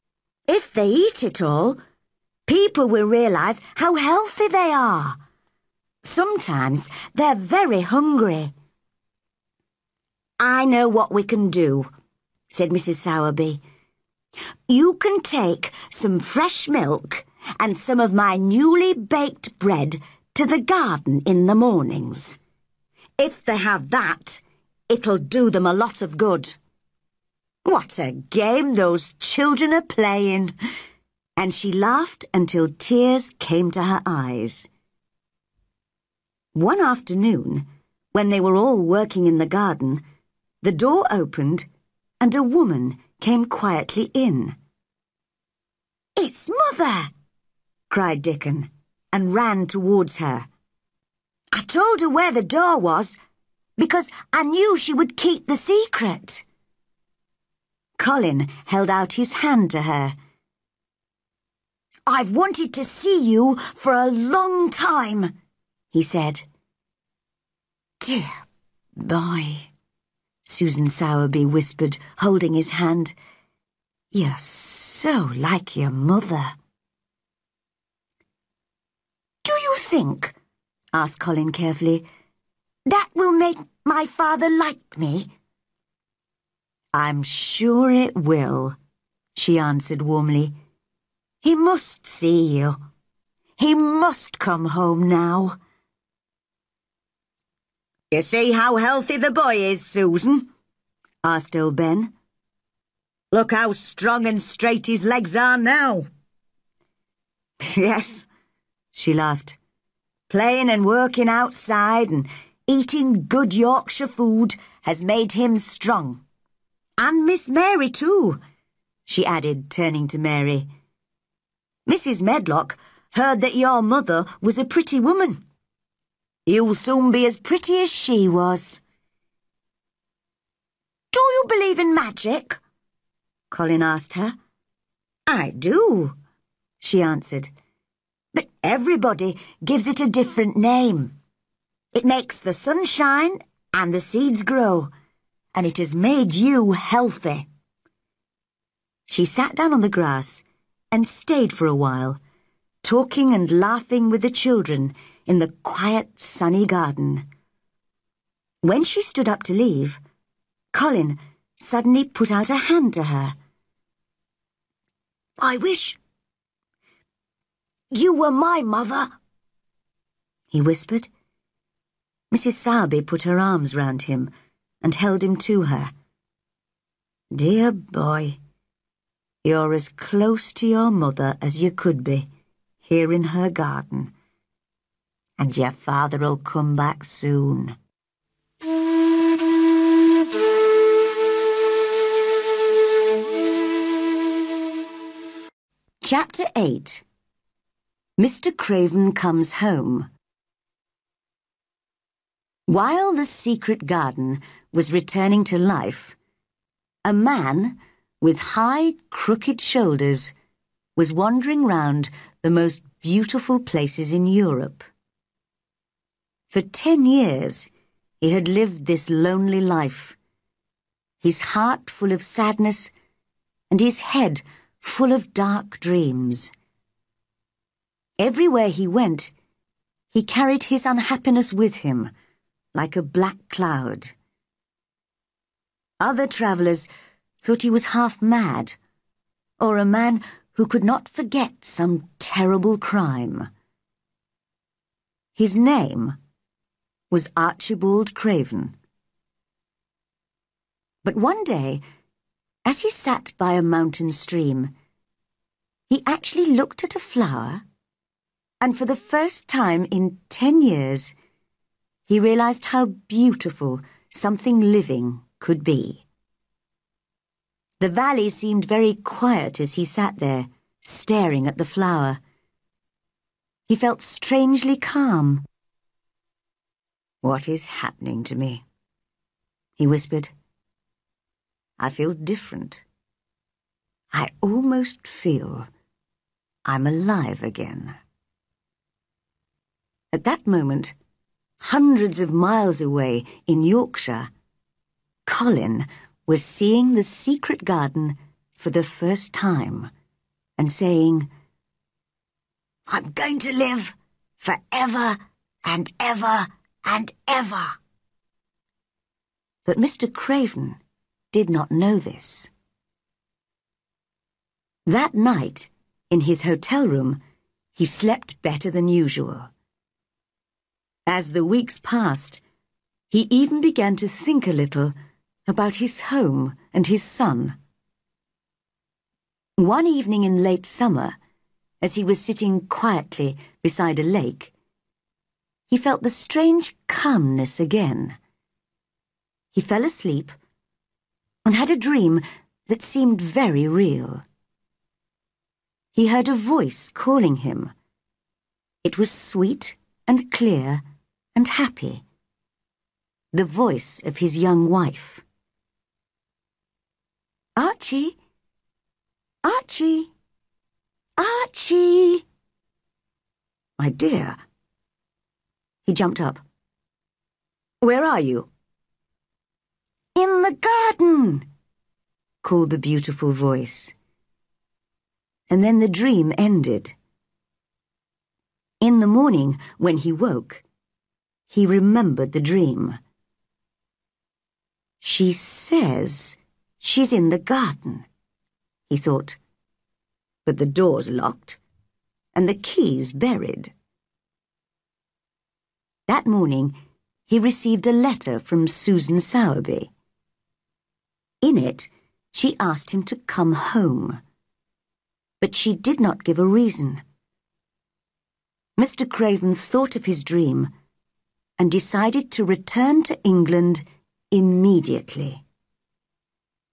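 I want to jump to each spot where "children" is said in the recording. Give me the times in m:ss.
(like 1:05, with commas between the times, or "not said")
0:29, 2:34.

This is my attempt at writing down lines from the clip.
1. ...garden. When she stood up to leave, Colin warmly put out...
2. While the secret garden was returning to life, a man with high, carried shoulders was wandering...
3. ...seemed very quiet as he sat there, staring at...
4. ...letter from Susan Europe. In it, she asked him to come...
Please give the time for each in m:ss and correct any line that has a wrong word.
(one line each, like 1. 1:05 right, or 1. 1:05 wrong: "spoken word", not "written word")
1. 2:36 wrong: "suddenly", not "warmly"
2. 3:22 wrong: "crooked", not "carried"
3. 4:28 right
4. 6:37 wrong: "Sowerby", not "Europe".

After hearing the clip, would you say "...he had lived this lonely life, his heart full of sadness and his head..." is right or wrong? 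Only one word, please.
right.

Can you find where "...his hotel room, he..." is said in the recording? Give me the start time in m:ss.
5:16.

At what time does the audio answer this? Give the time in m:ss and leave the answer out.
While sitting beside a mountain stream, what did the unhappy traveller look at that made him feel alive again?
4:16.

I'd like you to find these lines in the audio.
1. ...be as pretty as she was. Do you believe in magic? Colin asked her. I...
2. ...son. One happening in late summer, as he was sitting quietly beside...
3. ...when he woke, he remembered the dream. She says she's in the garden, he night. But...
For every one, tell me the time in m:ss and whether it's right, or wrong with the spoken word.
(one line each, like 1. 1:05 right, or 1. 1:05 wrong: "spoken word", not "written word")
1. 2:07 right
2. 5:27 wrong: "evening", not "happening"
3. 6:19 wrong: "thought", not "night".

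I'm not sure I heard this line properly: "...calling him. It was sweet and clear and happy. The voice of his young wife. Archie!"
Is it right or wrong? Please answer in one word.
right.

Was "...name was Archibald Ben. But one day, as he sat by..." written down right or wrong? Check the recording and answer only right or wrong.
wrong.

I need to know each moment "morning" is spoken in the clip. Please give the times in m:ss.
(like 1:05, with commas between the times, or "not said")
0:21, 6:19, 6:36.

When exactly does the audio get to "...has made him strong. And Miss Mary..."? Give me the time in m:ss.
1:54.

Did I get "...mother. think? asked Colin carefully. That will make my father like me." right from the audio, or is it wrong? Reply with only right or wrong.
right.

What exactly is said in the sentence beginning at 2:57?
Dear boy, you're as close to your mother as you could be, here in her garden.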